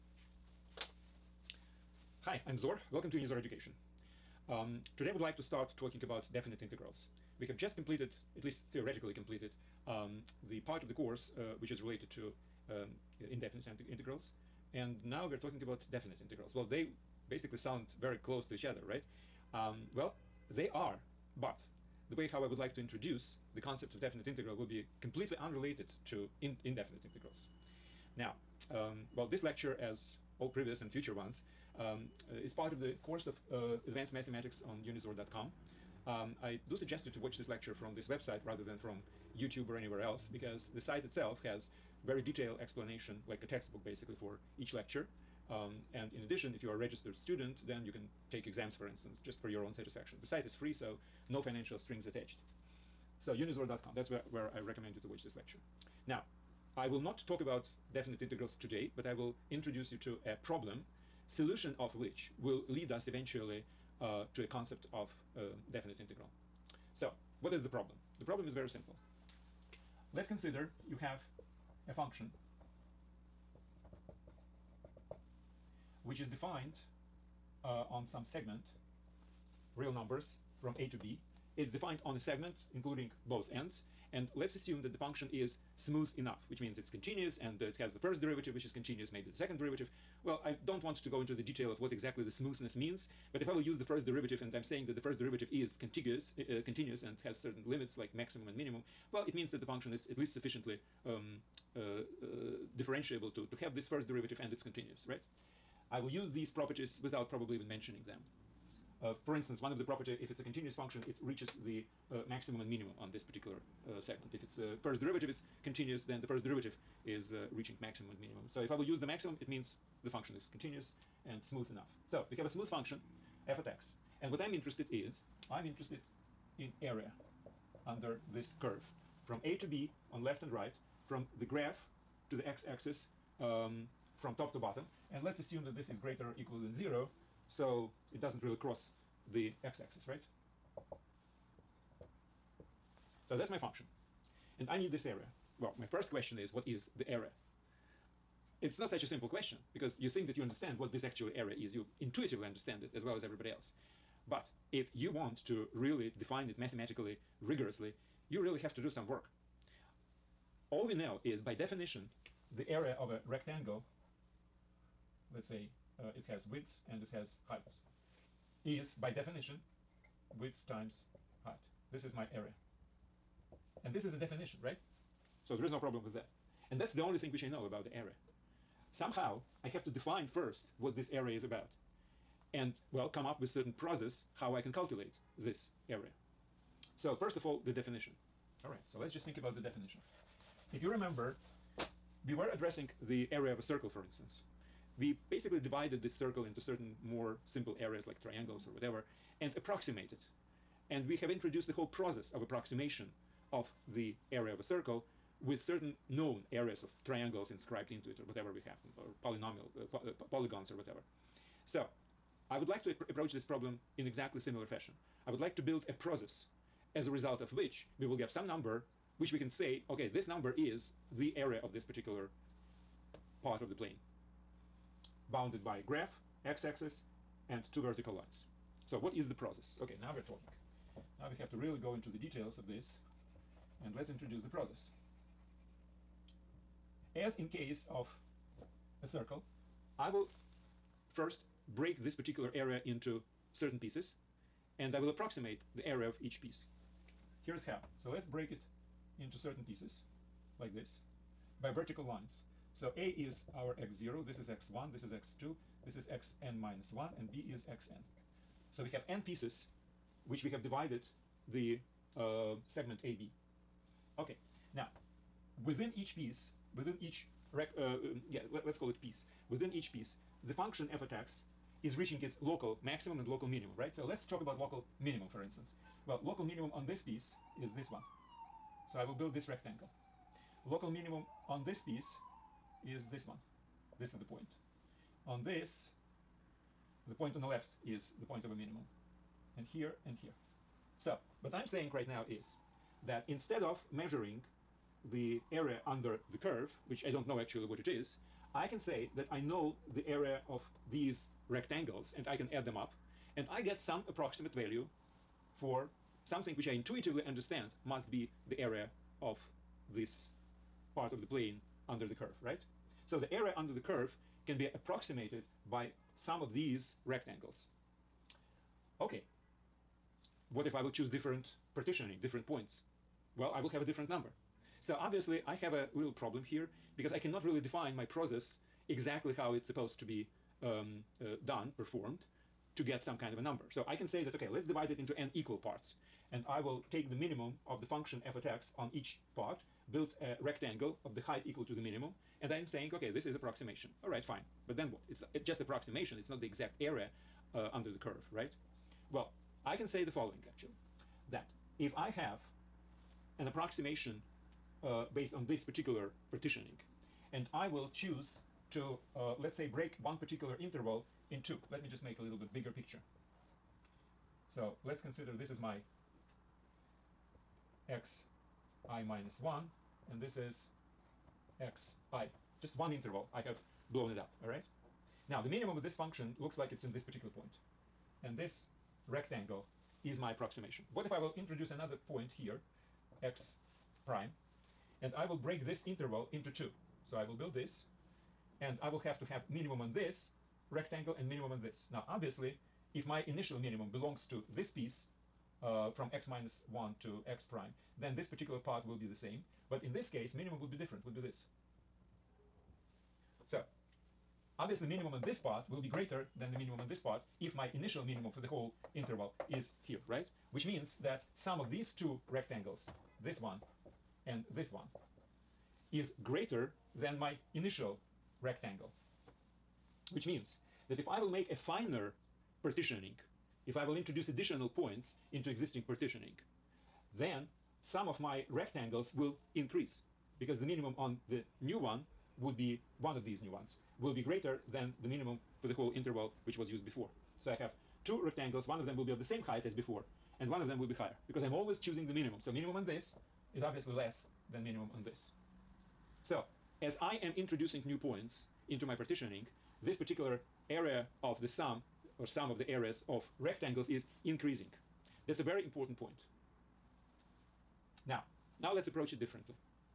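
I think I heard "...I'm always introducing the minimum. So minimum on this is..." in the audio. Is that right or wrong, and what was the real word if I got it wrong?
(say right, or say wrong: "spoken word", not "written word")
wrong: "choosing", not "introducing".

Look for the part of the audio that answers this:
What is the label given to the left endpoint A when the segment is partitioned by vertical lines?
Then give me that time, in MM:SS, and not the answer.
04:13.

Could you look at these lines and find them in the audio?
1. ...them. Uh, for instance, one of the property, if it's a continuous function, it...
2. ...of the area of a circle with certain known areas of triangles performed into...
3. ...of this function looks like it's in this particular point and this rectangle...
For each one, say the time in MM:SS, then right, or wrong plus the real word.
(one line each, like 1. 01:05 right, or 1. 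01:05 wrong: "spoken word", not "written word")
1. 01:48 right
2. 03:23 wrong: "inscribed", not "performed"
3. 06:15 right.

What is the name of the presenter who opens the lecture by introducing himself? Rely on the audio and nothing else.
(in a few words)
Zor.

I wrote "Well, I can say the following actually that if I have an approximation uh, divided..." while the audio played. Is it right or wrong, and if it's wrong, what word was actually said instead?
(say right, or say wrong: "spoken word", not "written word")
wrong: "based", not "divided".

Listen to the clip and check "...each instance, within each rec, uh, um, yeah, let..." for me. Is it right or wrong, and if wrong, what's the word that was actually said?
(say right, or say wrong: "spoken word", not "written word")
wrong: "piece", not "instance".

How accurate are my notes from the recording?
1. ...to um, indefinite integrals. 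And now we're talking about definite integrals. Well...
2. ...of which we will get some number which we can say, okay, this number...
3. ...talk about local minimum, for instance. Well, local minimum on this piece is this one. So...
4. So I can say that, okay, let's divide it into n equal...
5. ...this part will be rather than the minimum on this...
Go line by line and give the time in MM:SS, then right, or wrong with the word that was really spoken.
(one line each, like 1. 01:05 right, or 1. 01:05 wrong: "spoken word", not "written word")
1. 00:12 right
2. 03:37 right
3. 04:34 right
4. 05:33 right
5. 06:45 wrong: "greater", not "rather".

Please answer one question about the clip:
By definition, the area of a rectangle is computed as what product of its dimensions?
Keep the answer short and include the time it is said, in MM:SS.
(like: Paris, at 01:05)
width times height, at 02:50.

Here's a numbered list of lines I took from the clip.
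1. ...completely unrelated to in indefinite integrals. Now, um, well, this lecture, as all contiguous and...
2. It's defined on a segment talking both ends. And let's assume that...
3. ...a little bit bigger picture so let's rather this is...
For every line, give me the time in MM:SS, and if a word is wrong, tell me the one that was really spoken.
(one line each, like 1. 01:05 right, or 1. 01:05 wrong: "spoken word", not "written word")
1. 00:25 wrong: "previous", not "contiguous"
2. 01:21 wrong: "including", not "talking"
3. 06:02 wrong: "consider", not "rather".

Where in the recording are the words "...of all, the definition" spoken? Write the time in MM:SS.
03:07.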